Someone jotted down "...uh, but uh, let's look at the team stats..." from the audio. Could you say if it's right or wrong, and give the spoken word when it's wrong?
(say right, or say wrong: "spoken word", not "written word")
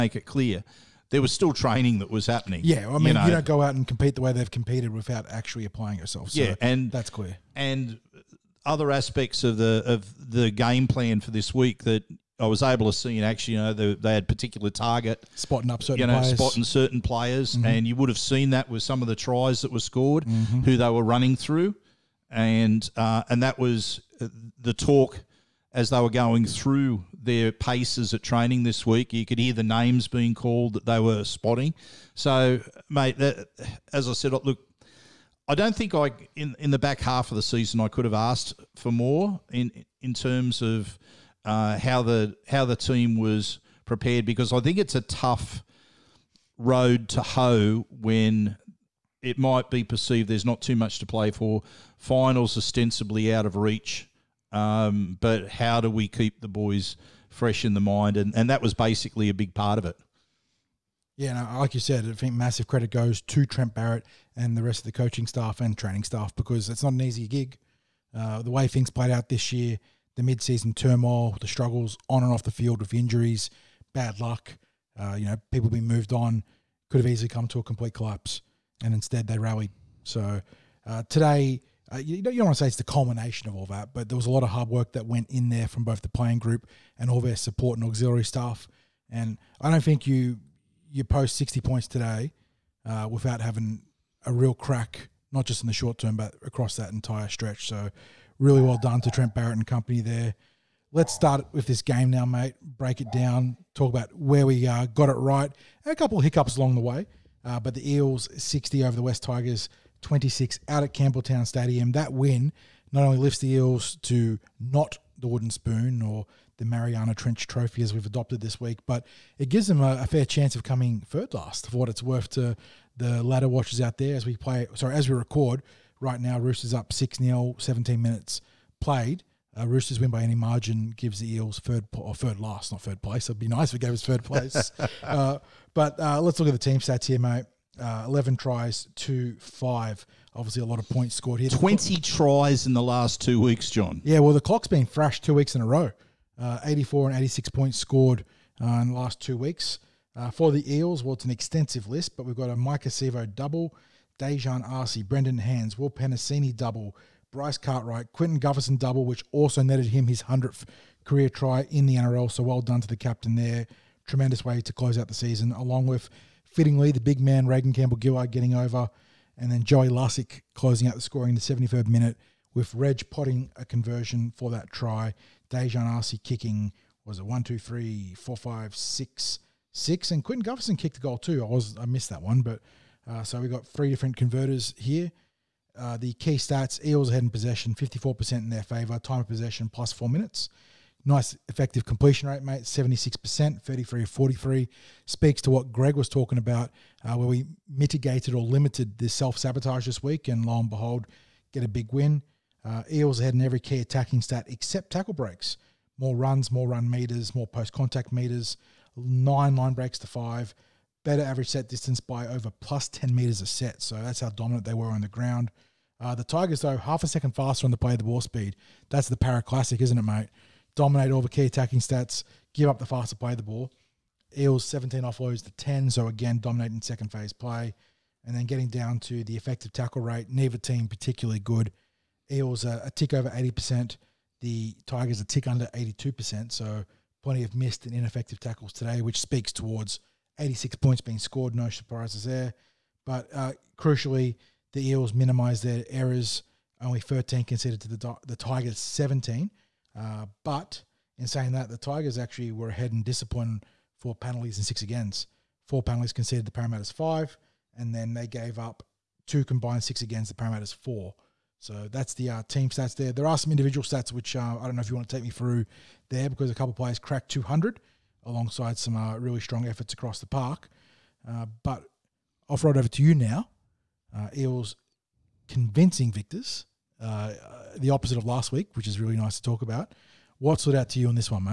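right.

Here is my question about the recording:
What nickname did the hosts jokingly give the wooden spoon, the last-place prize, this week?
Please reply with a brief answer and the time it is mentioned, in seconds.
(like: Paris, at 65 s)
Mariana Trench Trophy, at 116 s.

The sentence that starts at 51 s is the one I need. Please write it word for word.
Finals ostensibly out of reach um, but how do we keep the boys fresh in the mind?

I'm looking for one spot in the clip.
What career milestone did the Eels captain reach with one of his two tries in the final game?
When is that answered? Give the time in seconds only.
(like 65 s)
160 s.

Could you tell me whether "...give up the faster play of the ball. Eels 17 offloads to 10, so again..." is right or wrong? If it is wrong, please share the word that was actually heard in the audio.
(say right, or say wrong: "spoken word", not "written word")
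right.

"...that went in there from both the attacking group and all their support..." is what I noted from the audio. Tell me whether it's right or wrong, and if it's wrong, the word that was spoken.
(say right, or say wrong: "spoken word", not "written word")
wrong: "playing", not "attacking".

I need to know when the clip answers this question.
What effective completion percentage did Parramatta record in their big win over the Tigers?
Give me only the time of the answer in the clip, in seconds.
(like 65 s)
192 s.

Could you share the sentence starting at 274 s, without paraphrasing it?
Uh, Eels convincing victors uh, the opposite of last week, which is really nice to talk about.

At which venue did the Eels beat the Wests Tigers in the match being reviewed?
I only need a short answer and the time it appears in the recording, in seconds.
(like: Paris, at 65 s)
Campbelltown Stadium, at 110 s.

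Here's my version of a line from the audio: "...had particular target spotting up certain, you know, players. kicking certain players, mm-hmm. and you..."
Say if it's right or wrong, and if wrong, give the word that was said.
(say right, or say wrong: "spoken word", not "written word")
wrong: "spotting", not "kicking".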